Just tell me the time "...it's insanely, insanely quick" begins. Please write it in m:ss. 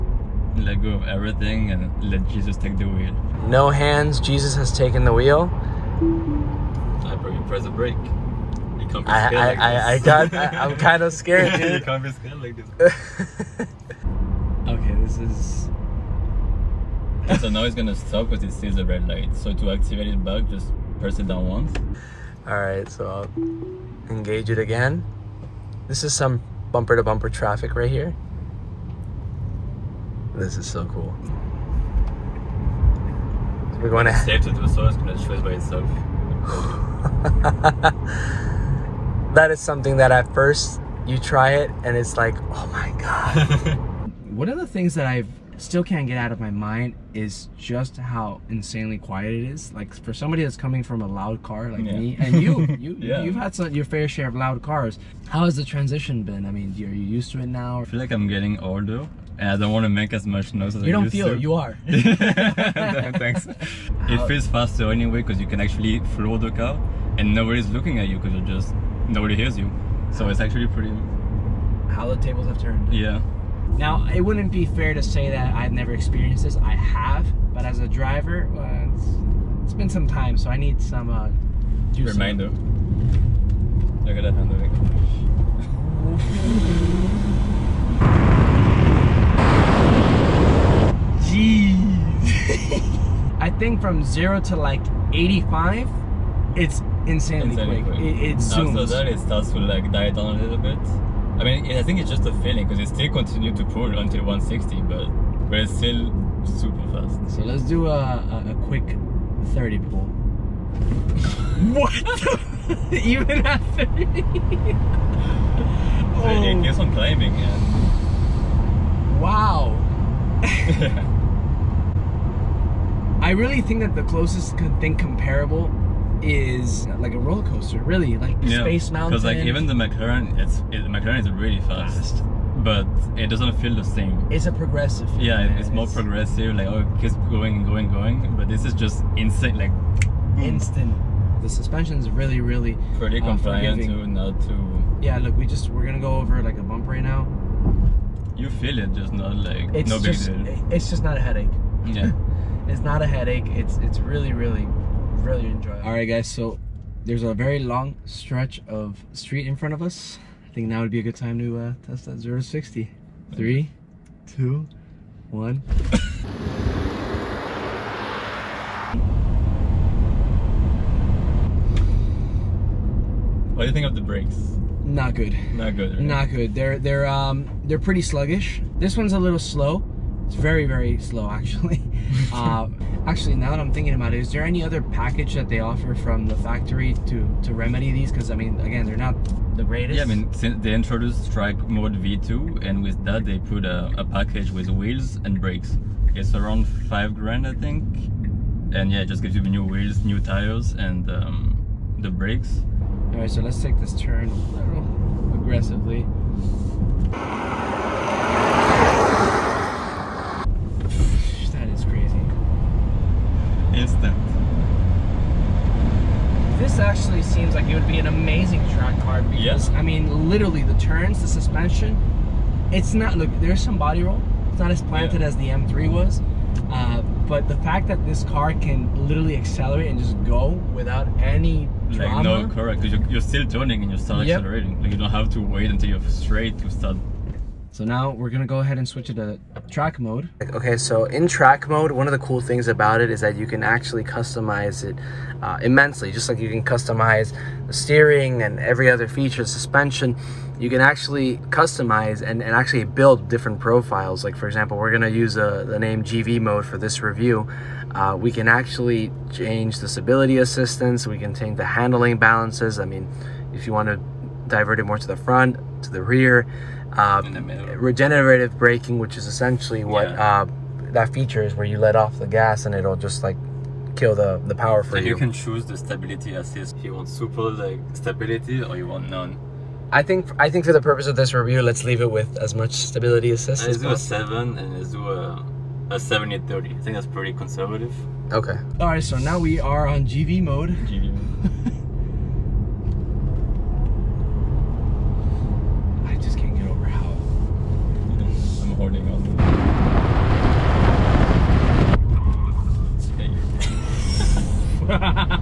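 1:36.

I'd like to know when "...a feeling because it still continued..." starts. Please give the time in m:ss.
1:42.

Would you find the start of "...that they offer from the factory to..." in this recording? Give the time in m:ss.
3:05.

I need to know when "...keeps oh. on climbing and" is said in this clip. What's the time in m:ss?
1:56.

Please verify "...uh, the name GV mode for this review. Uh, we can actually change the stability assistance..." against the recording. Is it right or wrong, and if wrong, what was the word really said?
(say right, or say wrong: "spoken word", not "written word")
right.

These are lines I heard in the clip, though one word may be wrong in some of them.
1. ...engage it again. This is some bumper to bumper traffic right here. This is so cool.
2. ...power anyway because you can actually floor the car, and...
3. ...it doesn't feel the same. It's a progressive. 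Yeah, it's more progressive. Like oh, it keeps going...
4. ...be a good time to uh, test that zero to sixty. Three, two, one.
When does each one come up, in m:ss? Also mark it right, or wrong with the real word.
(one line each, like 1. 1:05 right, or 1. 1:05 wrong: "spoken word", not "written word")
1. 0:24 right
2. 1:04 wrong: "faster", not "power"
3. 2:13 right
4. 2:40 right.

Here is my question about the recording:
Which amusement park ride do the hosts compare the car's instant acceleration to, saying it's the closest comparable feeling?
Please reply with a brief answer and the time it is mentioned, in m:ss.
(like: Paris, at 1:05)
Space Mountain, at 2:08.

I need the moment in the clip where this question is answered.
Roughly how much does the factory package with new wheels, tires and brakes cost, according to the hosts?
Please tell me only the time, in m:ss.
3:16.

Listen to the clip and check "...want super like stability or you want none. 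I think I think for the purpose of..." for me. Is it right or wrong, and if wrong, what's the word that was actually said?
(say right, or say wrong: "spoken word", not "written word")
right.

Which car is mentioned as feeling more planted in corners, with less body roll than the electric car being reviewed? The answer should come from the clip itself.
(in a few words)
M3.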